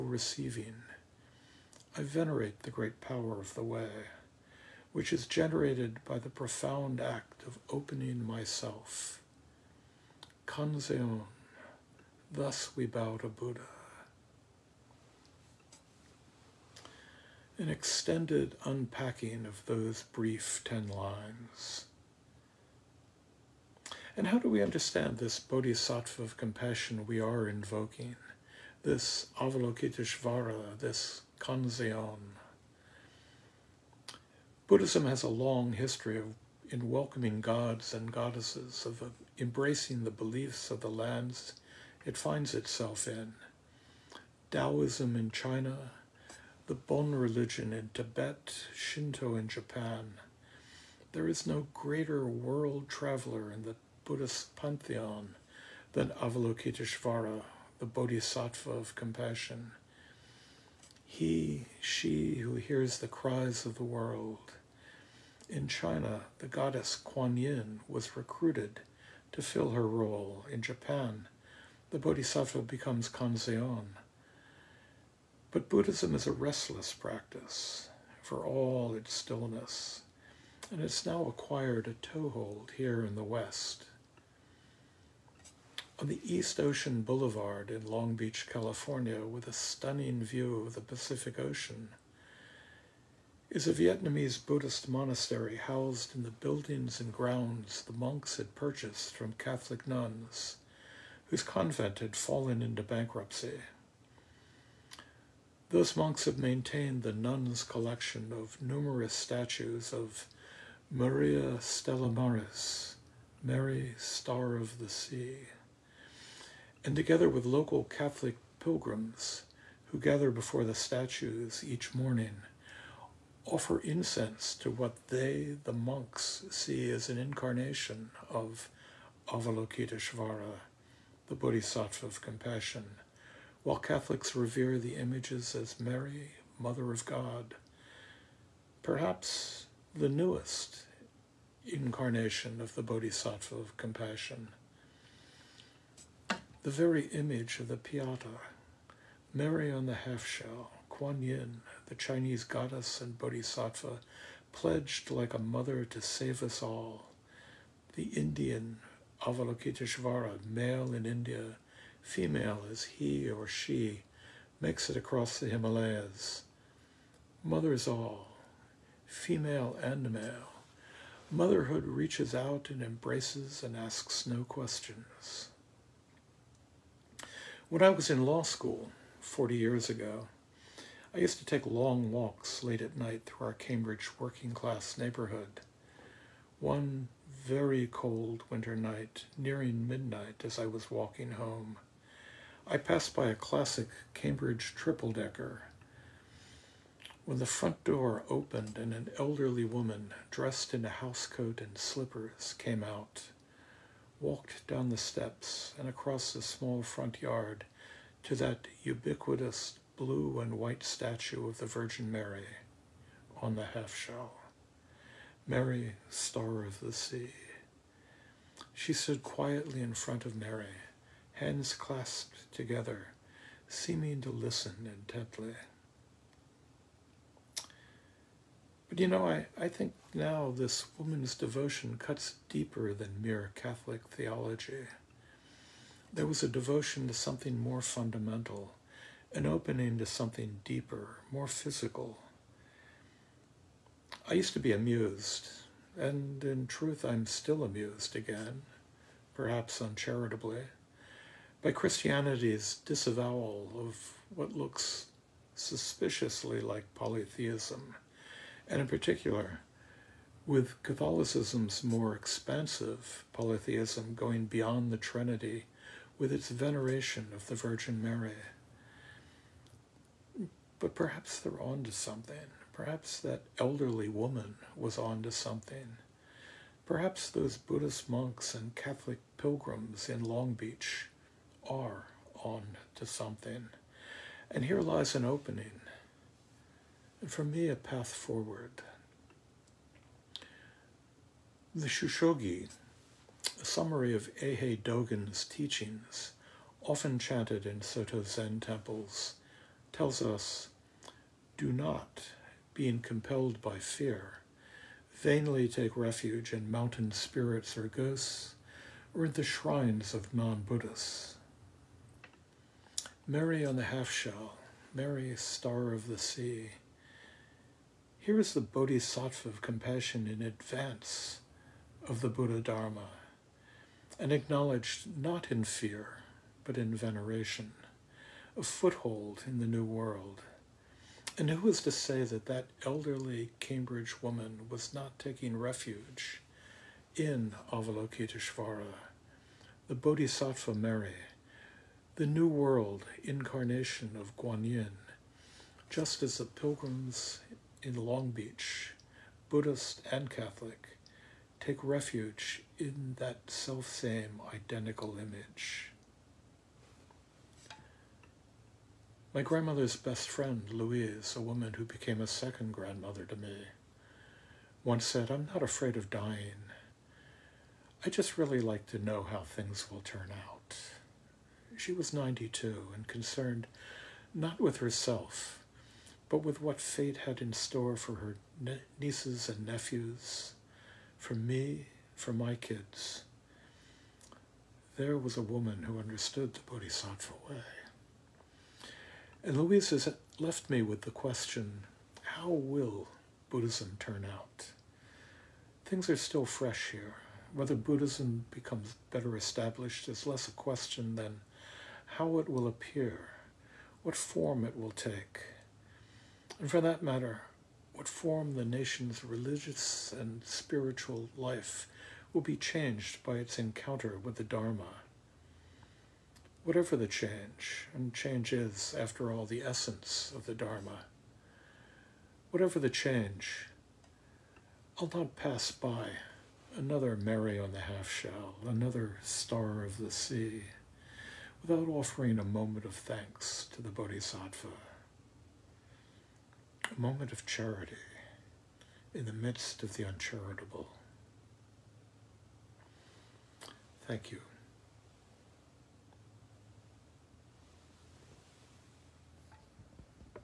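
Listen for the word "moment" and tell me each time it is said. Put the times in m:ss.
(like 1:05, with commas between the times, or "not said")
7:12, 7:16.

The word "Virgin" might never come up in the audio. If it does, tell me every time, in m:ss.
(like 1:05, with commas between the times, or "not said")
3:31, 4:27.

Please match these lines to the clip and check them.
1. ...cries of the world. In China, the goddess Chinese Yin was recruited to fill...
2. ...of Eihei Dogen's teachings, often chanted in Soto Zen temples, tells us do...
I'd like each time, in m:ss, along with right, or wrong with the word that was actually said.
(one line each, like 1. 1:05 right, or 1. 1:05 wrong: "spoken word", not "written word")
1. 1:03 wrong: "Kuan", not "Chinese"
2. 4:54 right.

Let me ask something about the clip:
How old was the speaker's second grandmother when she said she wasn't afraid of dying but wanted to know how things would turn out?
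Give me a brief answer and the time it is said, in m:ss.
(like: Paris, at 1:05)
92, at 6:12.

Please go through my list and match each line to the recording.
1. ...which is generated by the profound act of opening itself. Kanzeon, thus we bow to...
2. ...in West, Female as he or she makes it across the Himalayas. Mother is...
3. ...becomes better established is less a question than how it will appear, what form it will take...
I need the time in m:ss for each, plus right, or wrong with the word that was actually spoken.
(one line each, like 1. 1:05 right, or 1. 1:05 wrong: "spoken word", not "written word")
1. 0:04 wrong: "myself", not "itself"
2. 2:40 wrong: "India", not "West"
3. 6:38 right.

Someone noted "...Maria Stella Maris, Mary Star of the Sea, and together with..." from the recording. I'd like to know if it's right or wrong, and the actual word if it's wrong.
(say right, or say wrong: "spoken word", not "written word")
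right.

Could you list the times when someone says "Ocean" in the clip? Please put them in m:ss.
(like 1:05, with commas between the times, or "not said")
1:26, 1:31.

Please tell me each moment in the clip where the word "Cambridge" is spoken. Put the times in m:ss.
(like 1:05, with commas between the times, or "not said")
3:03, 3:14, 5:33.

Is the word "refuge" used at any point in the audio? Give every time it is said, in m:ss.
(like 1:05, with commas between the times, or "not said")
5:05, 5:35, 5:51.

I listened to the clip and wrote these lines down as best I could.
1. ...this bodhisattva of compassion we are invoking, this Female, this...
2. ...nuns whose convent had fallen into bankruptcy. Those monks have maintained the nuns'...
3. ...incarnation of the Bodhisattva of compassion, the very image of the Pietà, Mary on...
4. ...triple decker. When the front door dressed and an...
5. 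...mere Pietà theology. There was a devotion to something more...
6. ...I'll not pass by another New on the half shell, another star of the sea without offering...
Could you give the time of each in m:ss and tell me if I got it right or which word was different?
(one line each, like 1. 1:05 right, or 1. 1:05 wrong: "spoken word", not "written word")
1. 0:25 wrong: "Avalokiteshvara", not "Female"
2. 1:39 right
3. 2:21 right
4. 3:14 wrong: "opened", not "dressed"
5. 3:53 wrong: "Catholic", not "Pietà"
6. 7:04 wrong: "Mary", not "New".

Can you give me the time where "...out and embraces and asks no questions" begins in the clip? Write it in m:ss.
2:52.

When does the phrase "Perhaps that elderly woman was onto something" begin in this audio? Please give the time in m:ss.
4:32.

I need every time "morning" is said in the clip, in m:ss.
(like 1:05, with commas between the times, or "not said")
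2:01.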